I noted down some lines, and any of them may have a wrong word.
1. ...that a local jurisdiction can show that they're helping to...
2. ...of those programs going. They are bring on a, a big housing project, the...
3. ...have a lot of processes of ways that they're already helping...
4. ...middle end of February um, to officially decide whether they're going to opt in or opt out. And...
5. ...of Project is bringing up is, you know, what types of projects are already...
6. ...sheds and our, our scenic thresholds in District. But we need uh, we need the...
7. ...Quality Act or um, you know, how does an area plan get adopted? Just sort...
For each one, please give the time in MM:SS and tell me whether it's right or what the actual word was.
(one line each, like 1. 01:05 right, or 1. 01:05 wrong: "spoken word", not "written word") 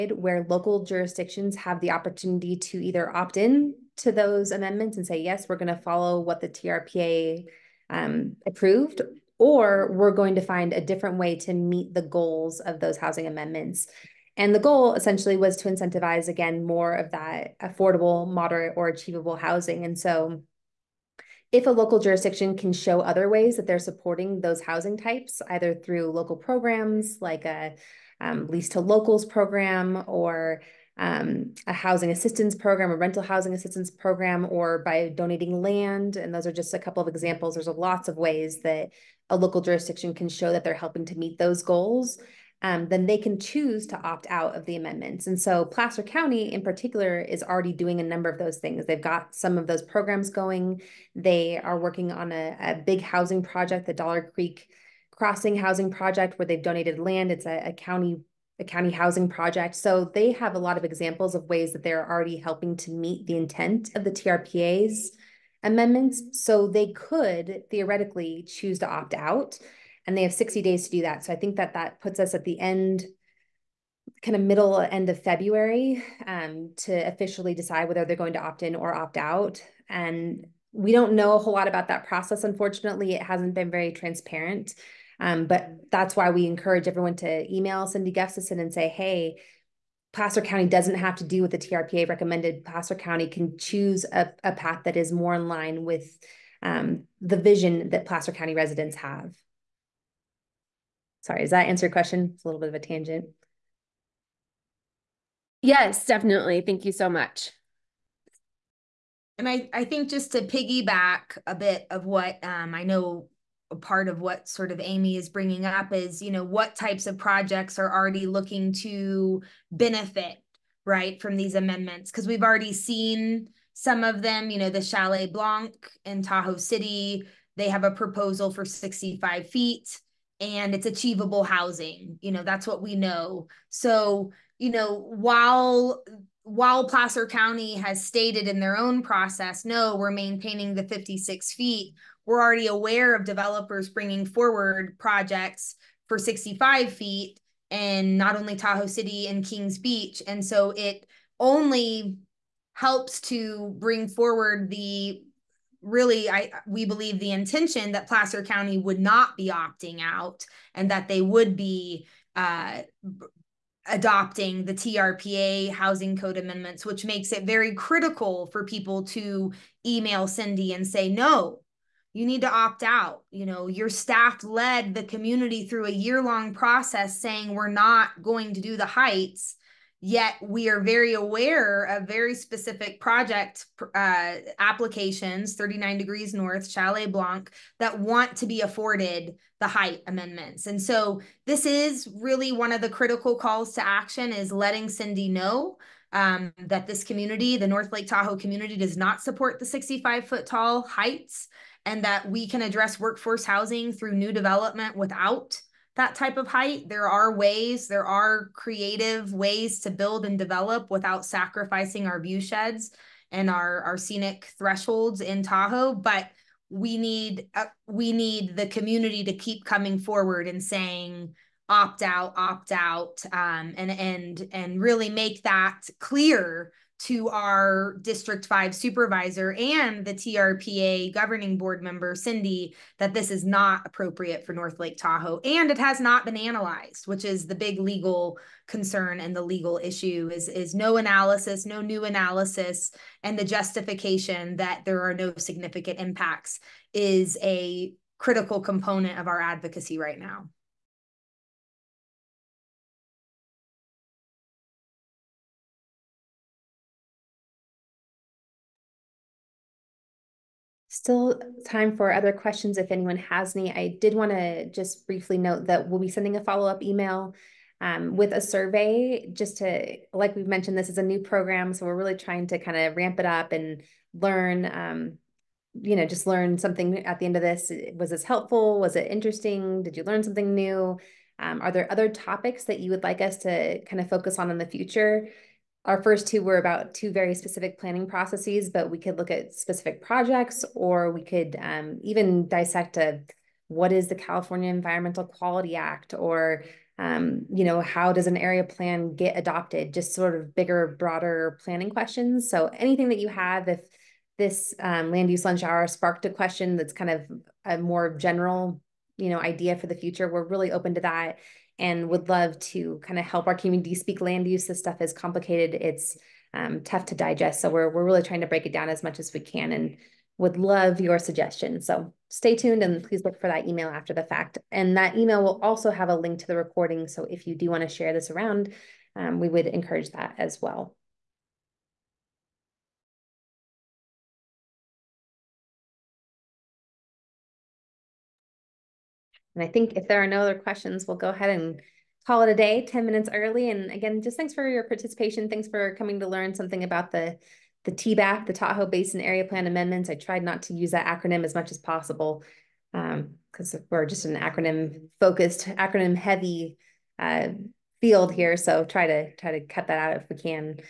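1. 00:38 right
2. 00:49 wrong: "working", not "bring"
3. 01:00 wrong: "examples", not "processes"
4. 01:14 right
5. 01:54 wrong: "Amy", not "Project"
6. 03:32 wrong: "Tahoe", not "District"
7. 04:55 right.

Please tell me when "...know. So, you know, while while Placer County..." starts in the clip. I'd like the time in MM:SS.
02:12.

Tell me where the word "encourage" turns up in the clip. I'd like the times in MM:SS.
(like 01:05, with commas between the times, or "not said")
01:26, 05:29.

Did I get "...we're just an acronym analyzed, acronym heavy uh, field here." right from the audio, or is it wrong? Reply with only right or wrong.
wrong.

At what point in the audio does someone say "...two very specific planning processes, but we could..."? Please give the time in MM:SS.
04:46.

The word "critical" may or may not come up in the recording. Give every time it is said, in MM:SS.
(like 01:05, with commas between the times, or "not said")
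02:47, 03:12, 04:08.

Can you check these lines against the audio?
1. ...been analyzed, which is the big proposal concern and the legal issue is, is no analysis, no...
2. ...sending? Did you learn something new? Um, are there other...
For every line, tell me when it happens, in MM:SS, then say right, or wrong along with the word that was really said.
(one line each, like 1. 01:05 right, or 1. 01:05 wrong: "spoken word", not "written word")
1. 03:56 wrong: "legal", not "proposal"
2. 04:39 wrong: "interesting", not "sending".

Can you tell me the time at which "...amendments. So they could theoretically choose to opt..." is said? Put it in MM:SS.
01:05.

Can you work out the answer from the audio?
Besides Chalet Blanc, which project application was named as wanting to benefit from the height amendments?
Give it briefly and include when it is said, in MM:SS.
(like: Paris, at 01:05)
39 Degrees North, at 03:05.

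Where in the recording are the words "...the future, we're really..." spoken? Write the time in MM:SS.
05:09.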